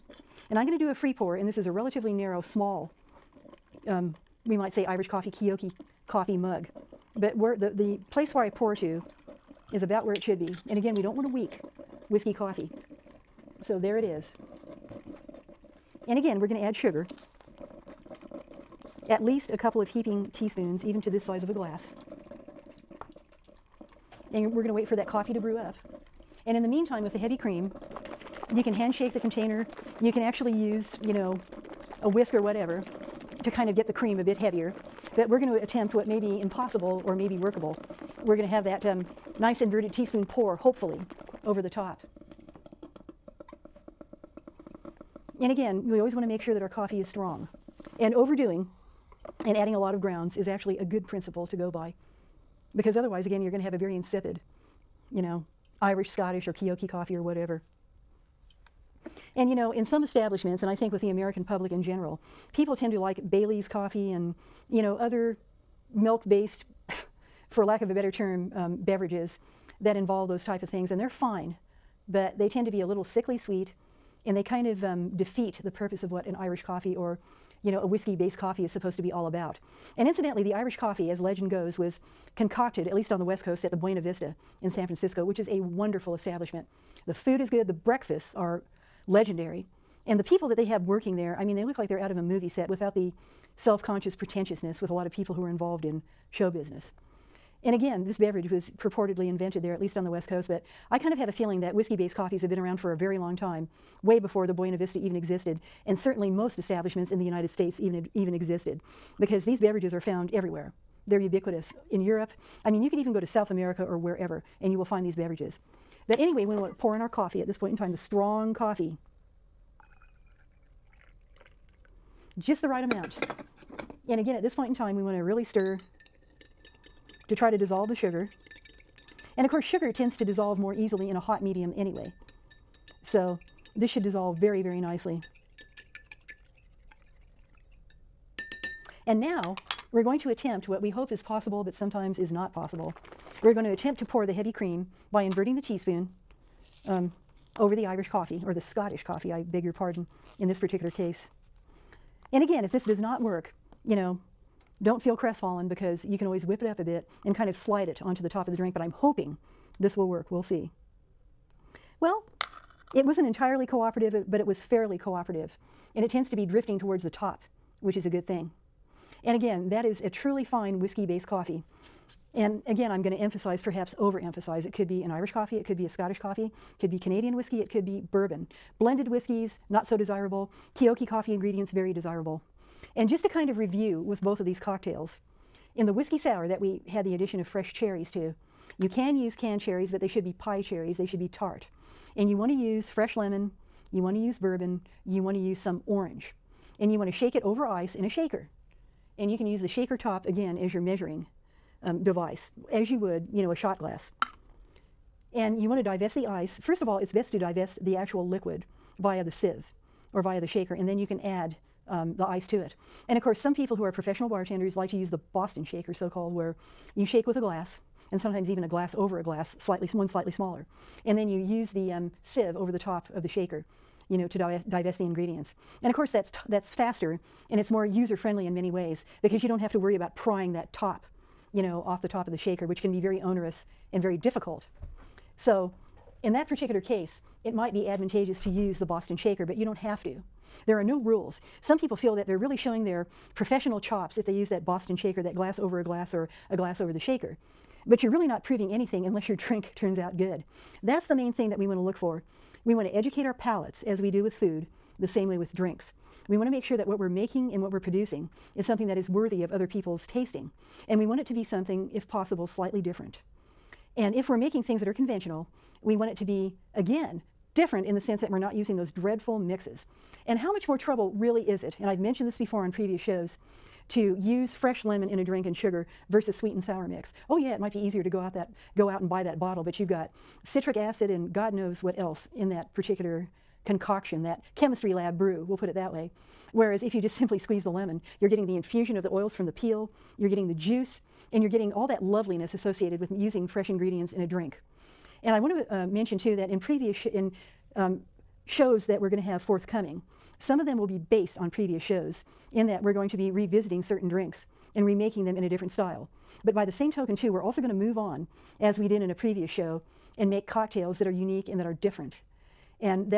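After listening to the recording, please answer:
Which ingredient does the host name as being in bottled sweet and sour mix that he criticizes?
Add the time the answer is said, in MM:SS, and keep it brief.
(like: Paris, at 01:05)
Citric acid, at 04:40.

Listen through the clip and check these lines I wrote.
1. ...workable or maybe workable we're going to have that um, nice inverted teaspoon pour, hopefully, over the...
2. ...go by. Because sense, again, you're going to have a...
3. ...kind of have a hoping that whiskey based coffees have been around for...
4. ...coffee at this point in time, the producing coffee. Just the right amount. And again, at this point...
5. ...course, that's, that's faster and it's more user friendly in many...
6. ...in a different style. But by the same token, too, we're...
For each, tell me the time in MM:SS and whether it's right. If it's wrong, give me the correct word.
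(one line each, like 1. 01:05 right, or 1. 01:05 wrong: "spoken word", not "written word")
1. 00:36 wrong: "impossible", not "workable"
2. 00:51 wrong: "otherwise", not "sense"
3. 01:40 wrong: "feeling", not "hoping"
4. 01:57 wrong: "strong", not "producing"
5. 03:45 right
6. 05:05 right.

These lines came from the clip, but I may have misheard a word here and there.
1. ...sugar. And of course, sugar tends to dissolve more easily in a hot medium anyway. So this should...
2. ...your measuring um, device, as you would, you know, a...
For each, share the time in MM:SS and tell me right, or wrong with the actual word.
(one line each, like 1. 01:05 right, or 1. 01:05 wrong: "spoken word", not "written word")
1. 02:07 right
2. 03:20 right.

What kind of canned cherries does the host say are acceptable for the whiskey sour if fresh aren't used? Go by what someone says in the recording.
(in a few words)
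Pie cherries.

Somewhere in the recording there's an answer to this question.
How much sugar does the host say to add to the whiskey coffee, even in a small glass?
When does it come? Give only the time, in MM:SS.
00:19.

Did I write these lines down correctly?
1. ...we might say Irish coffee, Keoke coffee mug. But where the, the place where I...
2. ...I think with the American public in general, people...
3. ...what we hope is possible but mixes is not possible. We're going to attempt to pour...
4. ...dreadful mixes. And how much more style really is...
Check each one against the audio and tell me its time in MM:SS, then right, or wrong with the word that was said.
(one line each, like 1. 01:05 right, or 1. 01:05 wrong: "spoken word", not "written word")
1. 00:04 right
2. 01:00 right
3. 02:20 wrong: "sometimes", not "mixes"
4. 04:28 wrong: "trouble", not "style".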